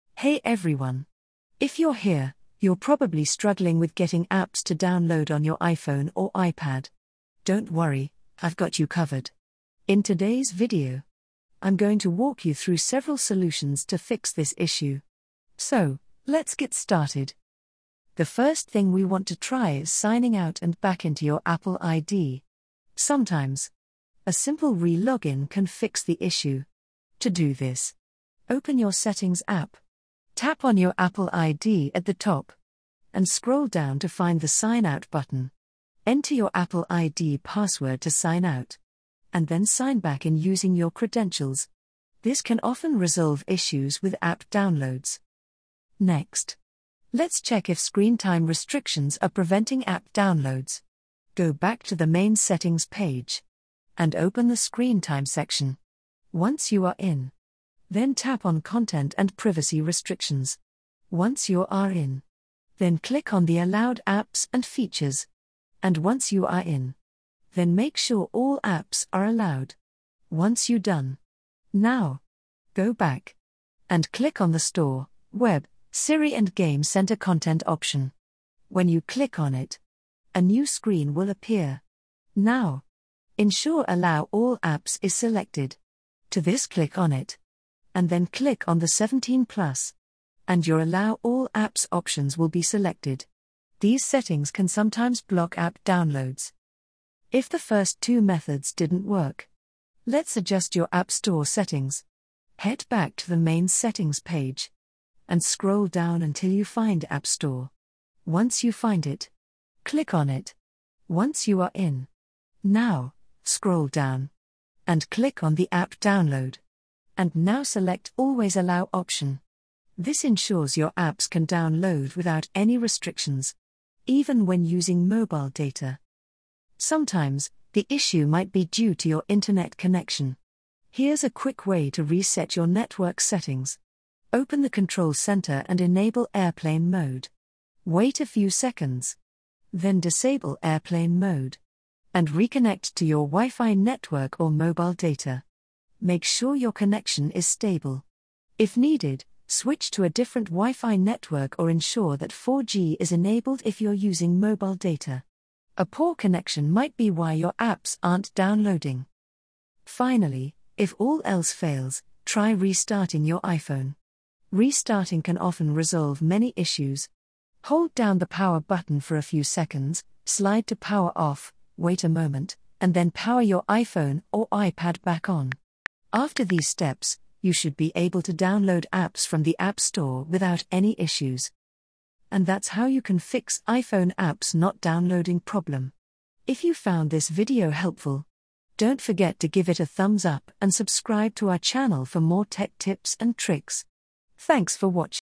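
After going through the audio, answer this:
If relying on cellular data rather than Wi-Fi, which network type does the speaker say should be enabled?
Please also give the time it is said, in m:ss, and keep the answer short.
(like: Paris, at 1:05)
4G, at 2:32.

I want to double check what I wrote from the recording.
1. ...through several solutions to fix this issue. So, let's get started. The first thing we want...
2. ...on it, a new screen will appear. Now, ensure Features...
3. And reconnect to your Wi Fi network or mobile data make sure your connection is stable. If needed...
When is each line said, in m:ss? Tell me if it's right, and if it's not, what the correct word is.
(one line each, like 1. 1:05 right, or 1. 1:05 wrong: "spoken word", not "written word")
1. 0:12 right
2. 1:19 wrong: "Allow", not "Features"
3. 2:22 right.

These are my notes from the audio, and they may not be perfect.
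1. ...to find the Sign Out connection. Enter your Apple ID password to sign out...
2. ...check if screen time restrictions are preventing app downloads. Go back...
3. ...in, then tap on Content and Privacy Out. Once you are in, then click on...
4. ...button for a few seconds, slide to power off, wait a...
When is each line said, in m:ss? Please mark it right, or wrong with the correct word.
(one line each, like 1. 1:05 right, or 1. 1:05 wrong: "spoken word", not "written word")
1. 0:33 wrong: "button", not "connection"
2. 0:47 right
3. 0:56 wrong: "Restrictions", not "Out"
4. 2:48 right.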